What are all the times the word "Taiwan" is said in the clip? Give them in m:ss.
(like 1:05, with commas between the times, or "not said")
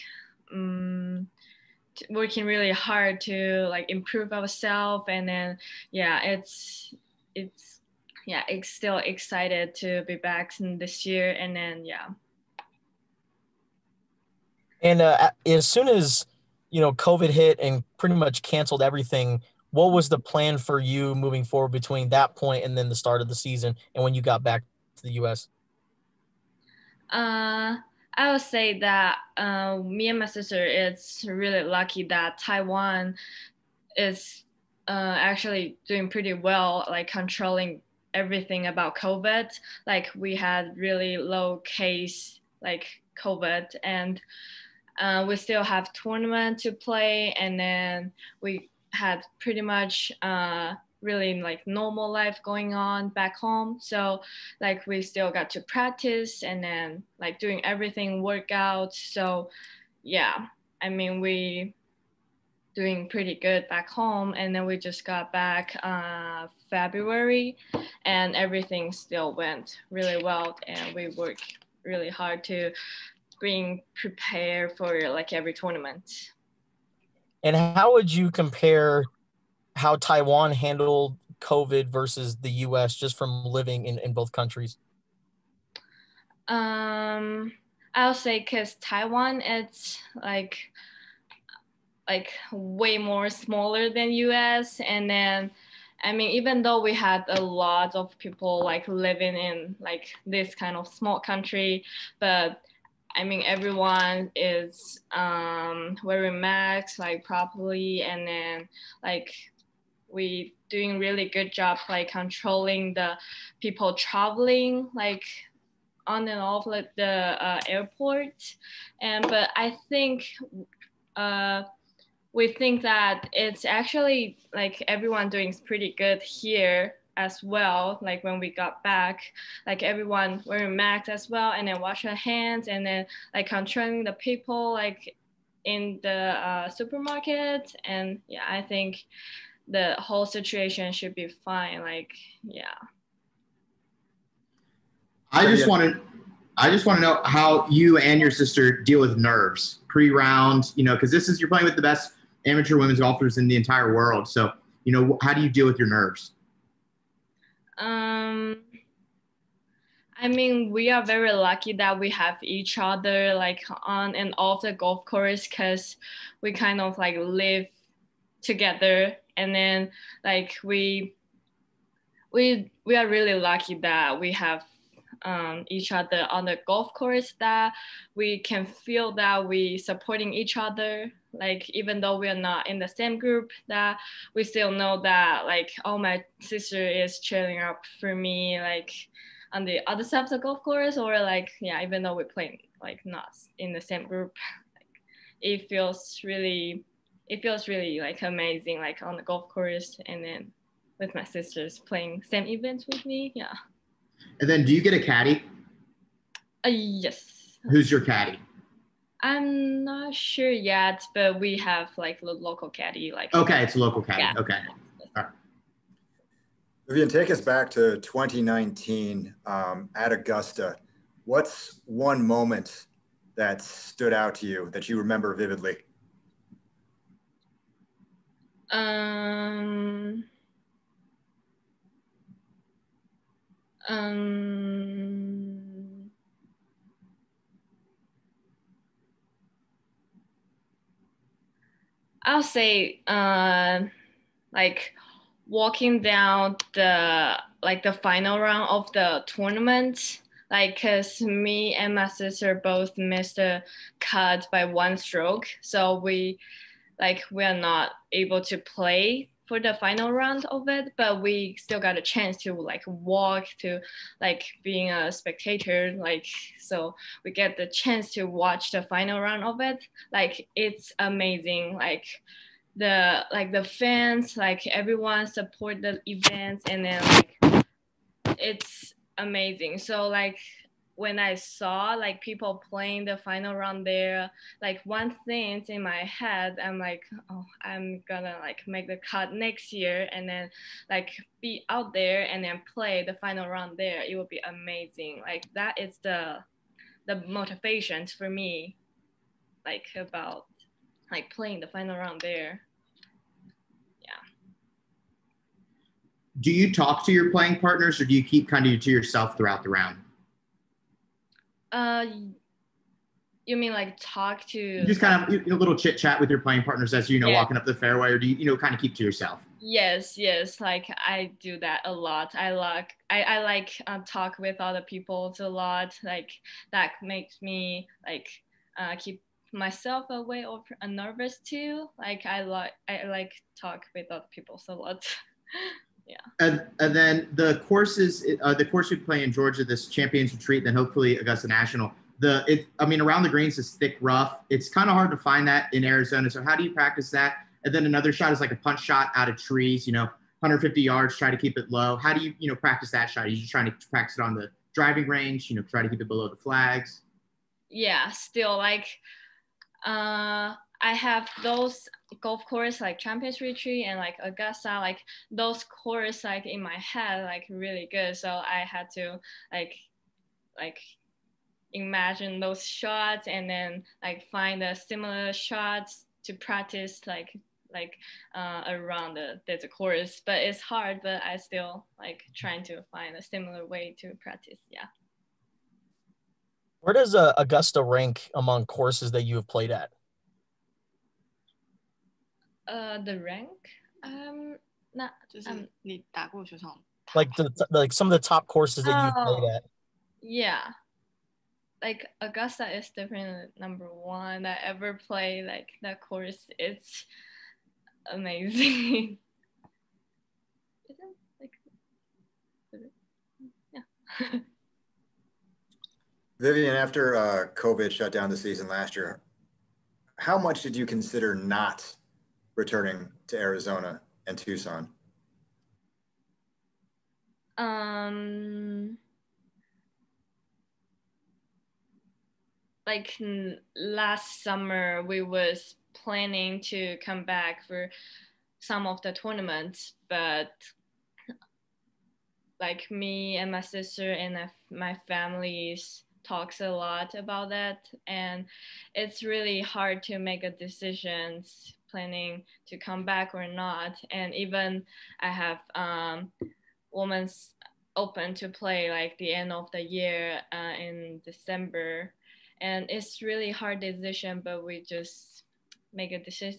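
0:32, 1:19, 1:28.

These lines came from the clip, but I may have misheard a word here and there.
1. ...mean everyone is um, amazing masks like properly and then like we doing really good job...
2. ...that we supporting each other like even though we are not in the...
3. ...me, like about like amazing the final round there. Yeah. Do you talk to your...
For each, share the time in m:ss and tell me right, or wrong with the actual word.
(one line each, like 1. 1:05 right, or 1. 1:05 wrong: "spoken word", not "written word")
1. 1:43 wrong: "wearing", not "amazing"
2. 2:59 right
3. 4:58 wrong: "playing", not "amazing".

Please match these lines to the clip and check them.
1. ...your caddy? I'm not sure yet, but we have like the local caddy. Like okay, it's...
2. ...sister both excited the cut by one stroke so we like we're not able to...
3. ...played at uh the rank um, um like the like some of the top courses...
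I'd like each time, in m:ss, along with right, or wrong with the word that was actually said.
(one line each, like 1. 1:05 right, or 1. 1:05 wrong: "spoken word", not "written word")
1. 3:27 right
2. 4:12 wrong: "missed", not "excited"
3. 6:29 right.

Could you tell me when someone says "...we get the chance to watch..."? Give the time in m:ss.
4:27.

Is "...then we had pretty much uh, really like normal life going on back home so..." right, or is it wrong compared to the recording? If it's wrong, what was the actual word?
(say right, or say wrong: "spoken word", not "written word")
right.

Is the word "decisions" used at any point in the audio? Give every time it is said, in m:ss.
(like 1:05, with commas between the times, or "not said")
7:30, 7:43.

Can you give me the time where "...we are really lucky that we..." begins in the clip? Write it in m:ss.
2:52.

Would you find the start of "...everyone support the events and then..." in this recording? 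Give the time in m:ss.
4:34.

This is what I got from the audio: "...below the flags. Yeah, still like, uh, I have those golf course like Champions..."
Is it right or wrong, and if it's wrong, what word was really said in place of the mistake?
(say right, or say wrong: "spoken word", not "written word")
right.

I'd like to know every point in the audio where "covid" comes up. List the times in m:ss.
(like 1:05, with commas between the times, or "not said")
0:16, 0:38, 0:43, 1:21, 6:57.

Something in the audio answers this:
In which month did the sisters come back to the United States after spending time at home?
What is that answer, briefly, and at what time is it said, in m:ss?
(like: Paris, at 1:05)
February, at 1:06.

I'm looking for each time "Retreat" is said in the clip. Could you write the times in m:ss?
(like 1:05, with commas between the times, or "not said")
5:40, 6:03.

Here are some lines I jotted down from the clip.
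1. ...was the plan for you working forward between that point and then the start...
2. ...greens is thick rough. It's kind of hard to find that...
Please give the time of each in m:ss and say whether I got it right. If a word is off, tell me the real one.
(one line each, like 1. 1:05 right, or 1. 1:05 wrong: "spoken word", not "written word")
1. 0:19 wrong: "moving", not "working"
2. 5:43 right.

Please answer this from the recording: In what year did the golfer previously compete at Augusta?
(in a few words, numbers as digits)
2019.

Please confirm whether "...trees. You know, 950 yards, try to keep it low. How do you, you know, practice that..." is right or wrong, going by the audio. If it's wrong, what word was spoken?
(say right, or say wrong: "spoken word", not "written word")
wrong: "150", not "950".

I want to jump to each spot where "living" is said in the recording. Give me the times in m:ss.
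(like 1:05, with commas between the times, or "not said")
1:23, 1:38.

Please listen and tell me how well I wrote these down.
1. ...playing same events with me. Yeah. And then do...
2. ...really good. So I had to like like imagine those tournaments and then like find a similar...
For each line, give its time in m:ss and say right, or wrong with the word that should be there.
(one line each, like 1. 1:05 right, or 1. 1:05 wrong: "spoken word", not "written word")
1. 3:21 right
2. 6:07 wrong: "shots", not "tournaments".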